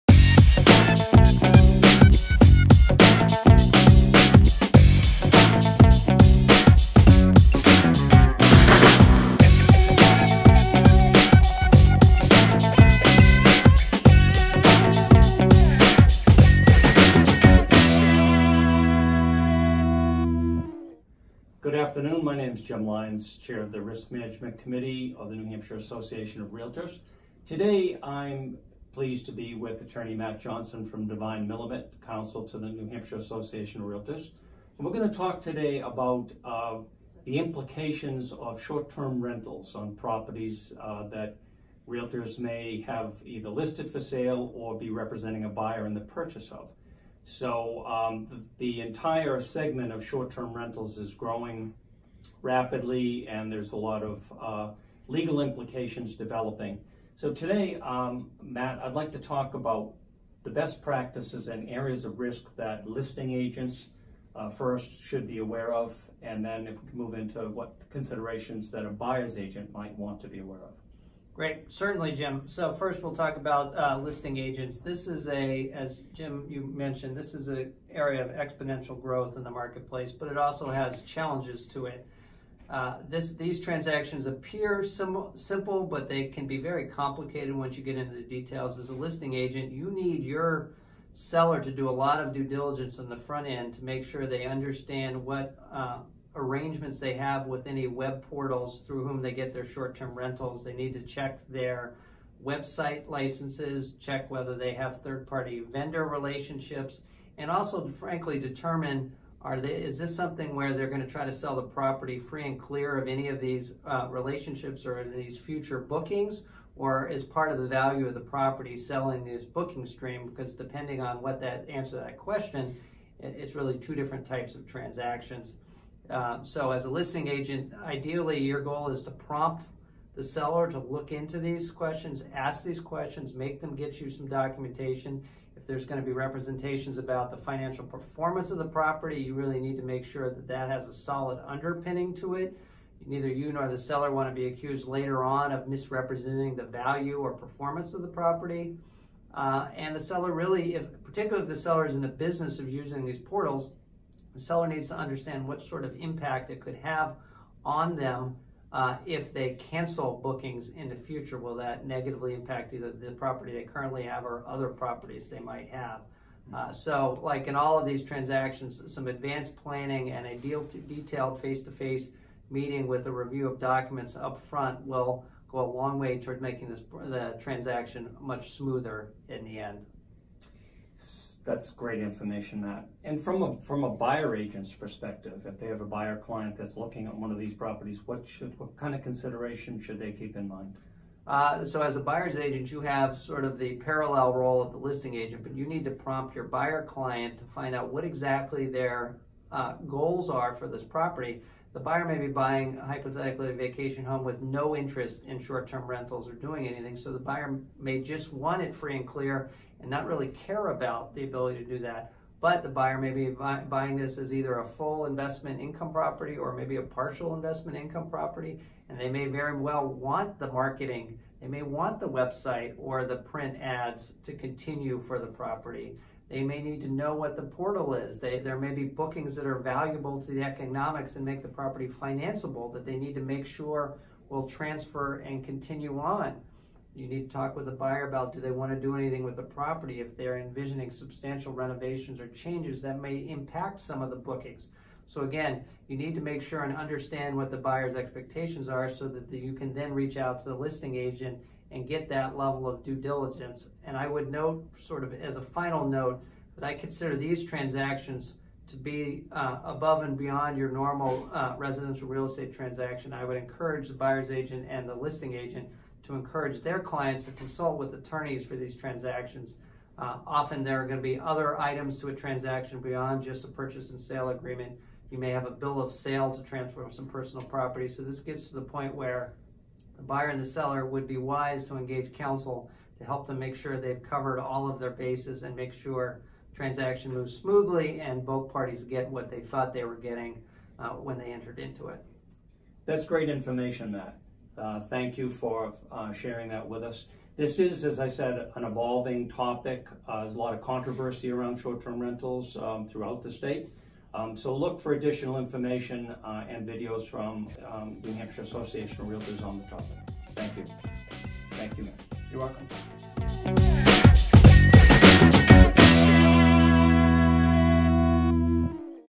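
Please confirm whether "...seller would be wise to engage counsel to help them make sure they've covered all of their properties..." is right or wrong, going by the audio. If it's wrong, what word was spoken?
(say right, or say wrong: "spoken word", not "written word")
wrong: "bases", not "properties".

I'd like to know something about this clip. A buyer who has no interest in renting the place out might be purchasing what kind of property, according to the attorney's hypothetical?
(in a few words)
vacation home.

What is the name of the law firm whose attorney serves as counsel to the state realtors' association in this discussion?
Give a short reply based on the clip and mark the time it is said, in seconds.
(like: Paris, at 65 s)
Devine Millimet, at 31 s.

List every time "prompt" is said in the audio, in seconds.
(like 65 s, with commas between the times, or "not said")
129 s, 195 s.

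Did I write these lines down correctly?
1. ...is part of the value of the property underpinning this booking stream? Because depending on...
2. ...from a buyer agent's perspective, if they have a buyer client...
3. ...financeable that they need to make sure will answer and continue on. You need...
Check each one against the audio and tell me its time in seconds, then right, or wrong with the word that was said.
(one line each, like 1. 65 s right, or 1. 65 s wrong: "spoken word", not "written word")
1. 117 s wrong: "selling", not "underpinning"
2. 183 s right
3. 231 s wrong: "transfer", not "answer".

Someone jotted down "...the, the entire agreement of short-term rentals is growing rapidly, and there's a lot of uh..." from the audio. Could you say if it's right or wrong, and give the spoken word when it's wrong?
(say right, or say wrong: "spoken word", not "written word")
wrong: "segment", not "agreement".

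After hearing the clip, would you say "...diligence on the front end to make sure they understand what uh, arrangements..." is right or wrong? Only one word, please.
right.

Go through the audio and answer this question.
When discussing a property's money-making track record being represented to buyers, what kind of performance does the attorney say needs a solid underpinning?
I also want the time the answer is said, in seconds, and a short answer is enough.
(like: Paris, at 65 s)
financial performance, at 137 s.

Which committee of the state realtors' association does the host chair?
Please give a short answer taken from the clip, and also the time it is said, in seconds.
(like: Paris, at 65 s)
Risk Management Committee, at 23 s.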